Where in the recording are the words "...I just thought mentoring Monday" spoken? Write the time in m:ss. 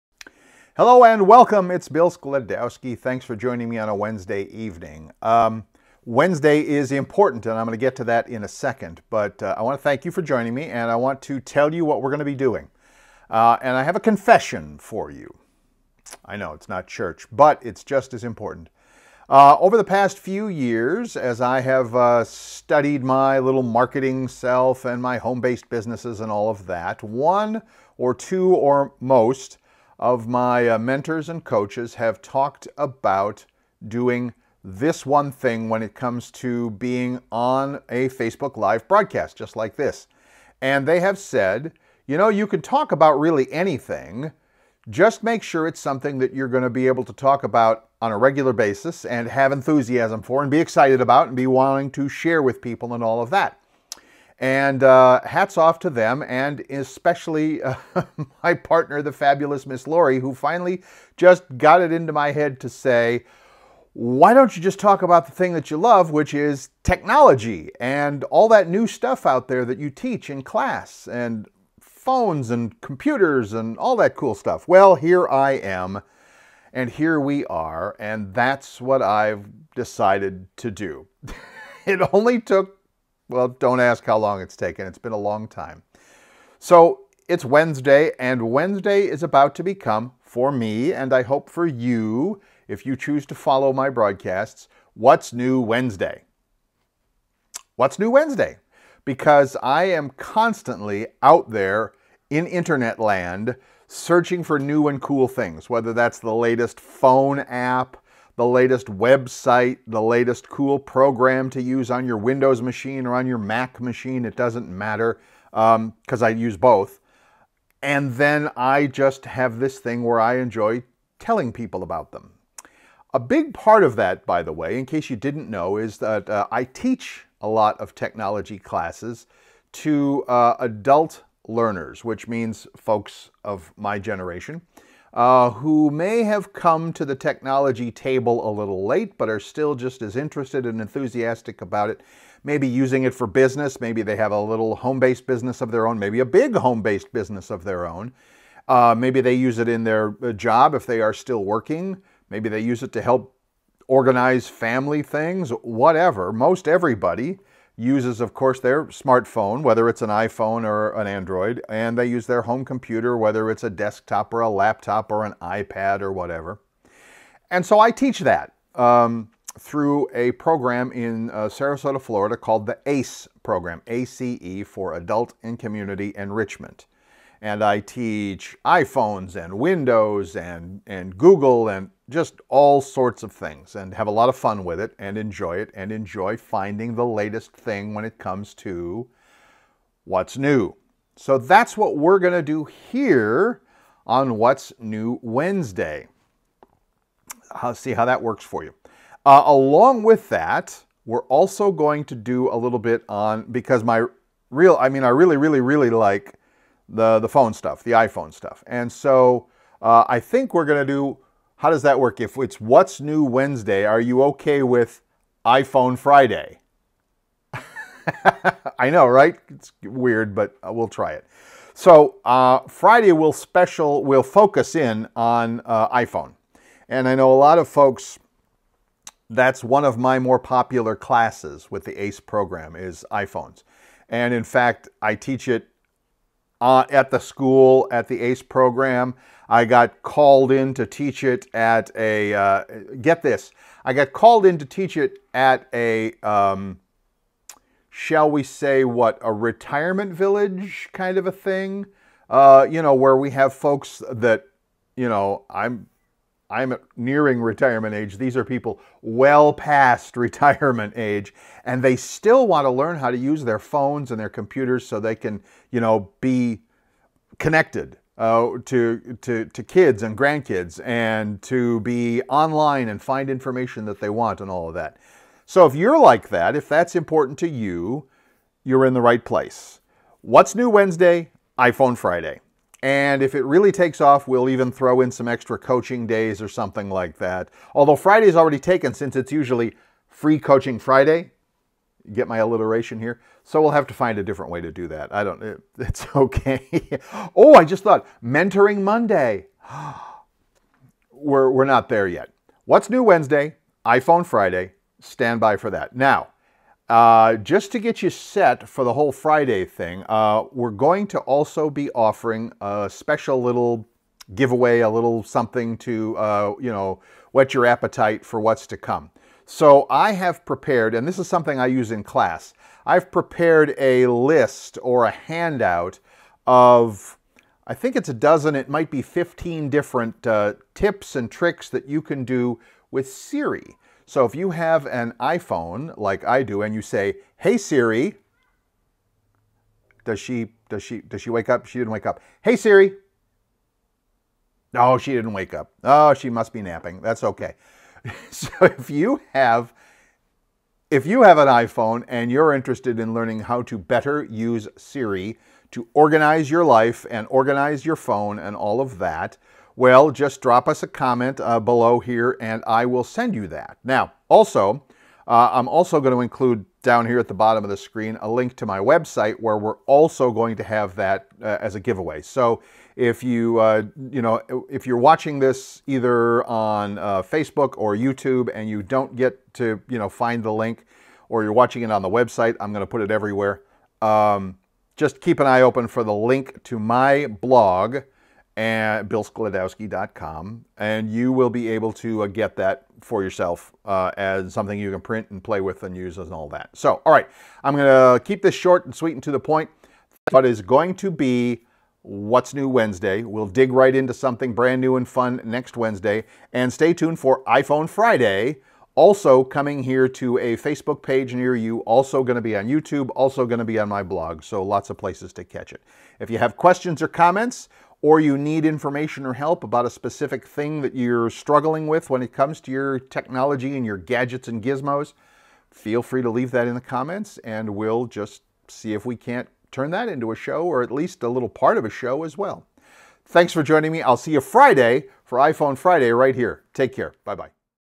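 4:57.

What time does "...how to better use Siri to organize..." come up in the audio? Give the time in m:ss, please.
5:53.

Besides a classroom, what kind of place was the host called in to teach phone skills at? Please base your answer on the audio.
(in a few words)
A retirement village.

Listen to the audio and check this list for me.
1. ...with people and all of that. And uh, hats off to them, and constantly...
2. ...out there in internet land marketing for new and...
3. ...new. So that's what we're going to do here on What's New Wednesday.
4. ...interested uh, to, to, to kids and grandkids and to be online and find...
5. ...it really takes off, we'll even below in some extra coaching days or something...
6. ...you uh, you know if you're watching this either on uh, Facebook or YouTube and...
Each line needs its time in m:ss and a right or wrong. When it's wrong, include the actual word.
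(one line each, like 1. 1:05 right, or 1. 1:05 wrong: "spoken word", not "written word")
1. 0:52 wrong: "especially", not "constantly"
2. 1:41 wrong: "searching", not "marketing"
3. 3:10 right
4. 4:27 wrong: "connected", not "interested"
5. 4:43 wrong: "throw", not "below"
6. 6:13 right.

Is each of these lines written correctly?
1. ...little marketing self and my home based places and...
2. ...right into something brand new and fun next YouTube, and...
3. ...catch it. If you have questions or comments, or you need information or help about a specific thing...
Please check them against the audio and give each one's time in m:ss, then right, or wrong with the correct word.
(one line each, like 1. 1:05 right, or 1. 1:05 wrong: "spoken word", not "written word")
1. 0:23 wrong: "businesses", not "places"
2. 6:43 wrong: "Wednesday", not "YouTube"
3. 6:55 right.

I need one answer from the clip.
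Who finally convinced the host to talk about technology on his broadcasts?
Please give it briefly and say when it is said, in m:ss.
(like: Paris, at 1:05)
Laurie, at 0:59.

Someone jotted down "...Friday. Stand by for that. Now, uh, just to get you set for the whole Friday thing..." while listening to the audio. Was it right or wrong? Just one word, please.
right.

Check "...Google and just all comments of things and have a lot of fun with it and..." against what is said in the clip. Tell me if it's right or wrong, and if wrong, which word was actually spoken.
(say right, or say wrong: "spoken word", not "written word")
wrong: "sorts", not "comments".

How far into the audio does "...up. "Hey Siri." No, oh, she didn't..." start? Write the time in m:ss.
5:42.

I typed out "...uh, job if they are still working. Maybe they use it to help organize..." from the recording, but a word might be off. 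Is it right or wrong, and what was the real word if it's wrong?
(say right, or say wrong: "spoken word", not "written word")
right.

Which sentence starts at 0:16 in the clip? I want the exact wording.
I know it's not church, but it's just as important.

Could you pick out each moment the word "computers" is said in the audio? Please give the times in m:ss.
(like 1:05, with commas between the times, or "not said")
1:12, 2:42, 4:24.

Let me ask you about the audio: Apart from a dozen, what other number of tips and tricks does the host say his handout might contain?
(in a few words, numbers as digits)
15.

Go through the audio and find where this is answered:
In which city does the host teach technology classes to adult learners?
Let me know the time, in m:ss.
2:51.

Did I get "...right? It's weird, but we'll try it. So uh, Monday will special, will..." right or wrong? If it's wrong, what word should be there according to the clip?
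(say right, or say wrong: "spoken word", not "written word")
wrong: "Friday", not "Monday".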